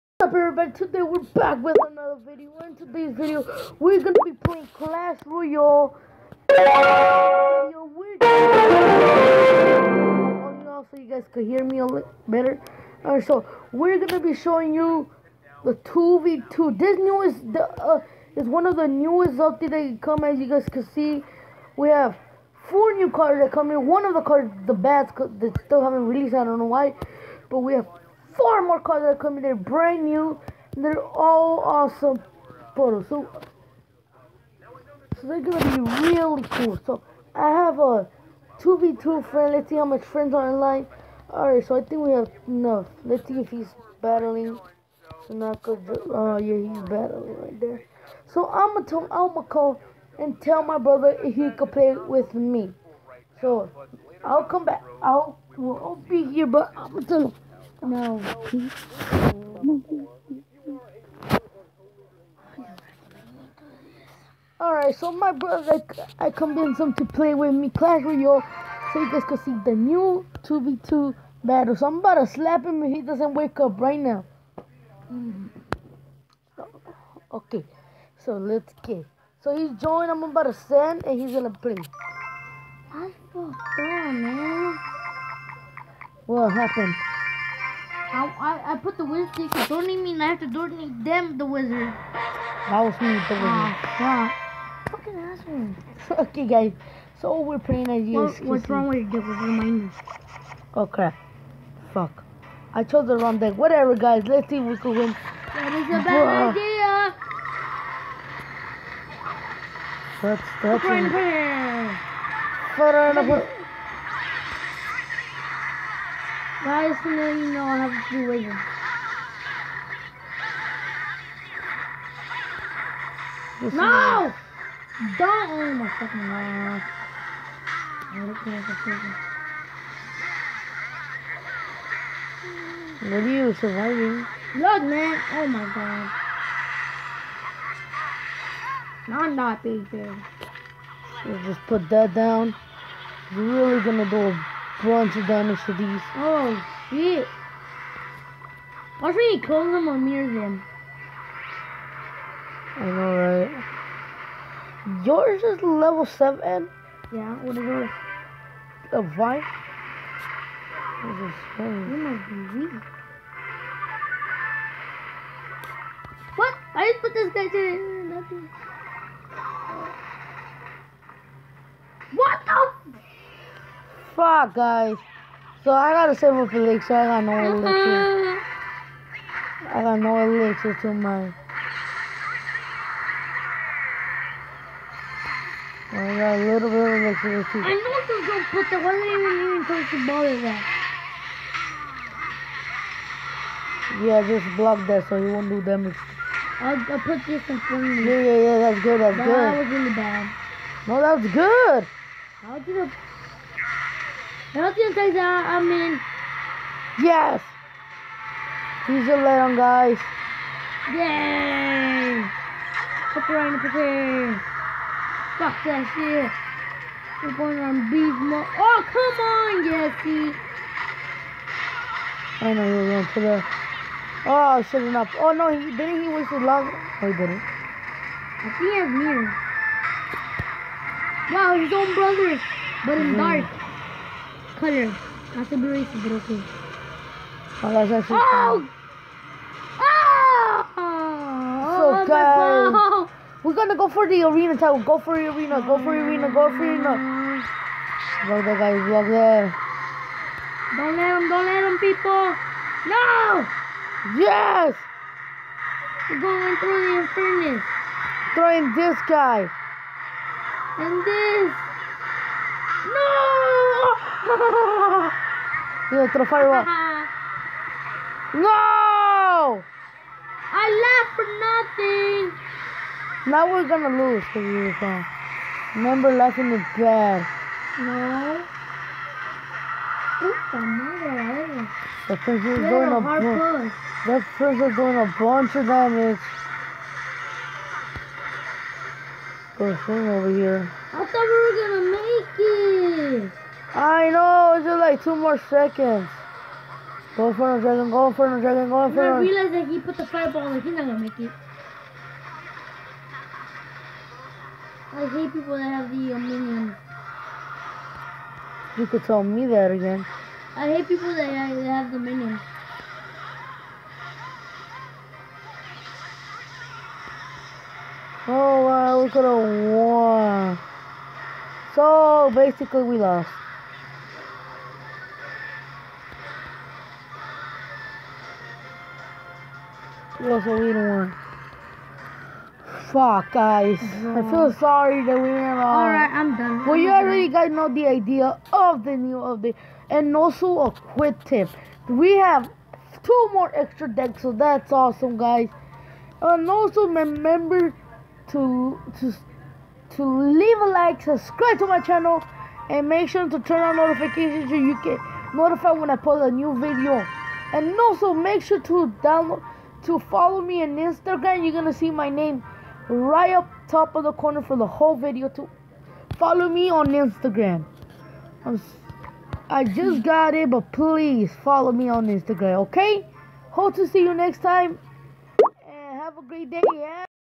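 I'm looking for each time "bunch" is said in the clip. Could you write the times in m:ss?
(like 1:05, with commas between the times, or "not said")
2:24, 4:45.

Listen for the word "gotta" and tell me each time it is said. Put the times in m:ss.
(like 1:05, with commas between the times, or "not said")
2:55.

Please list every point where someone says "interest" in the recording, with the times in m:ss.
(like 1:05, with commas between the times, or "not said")
not said.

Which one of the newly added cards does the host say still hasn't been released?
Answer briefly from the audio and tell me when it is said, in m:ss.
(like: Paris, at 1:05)
The bats, at 0:24.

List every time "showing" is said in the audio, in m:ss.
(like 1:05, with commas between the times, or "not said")
0:14.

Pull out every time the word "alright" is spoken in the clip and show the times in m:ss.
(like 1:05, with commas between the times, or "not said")
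0:13, 0:41, 1:04, 5:35.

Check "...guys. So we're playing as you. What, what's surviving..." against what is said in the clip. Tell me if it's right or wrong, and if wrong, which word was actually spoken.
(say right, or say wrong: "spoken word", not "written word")
wrong: "wrong", not "surviving".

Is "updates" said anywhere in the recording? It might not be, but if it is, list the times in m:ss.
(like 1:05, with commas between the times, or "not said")
0:19, 5:39.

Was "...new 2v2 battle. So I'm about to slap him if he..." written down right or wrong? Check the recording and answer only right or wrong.
right.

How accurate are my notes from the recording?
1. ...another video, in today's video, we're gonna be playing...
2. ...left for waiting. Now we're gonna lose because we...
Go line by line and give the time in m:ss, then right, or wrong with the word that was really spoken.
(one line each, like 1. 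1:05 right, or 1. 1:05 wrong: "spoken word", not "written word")
1. 0:01 right
2. 4:30 wrong: "nothing", not "waiting".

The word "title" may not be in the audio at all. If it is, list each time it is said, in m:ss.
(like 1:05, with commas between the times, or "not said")
4:04.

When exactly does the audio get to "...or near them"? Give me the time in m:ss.
2:29.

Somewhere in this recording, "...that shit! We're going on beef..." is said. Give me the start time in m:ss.
3:35.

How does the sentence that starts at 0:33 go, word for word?
So, so they're gonna be really cool.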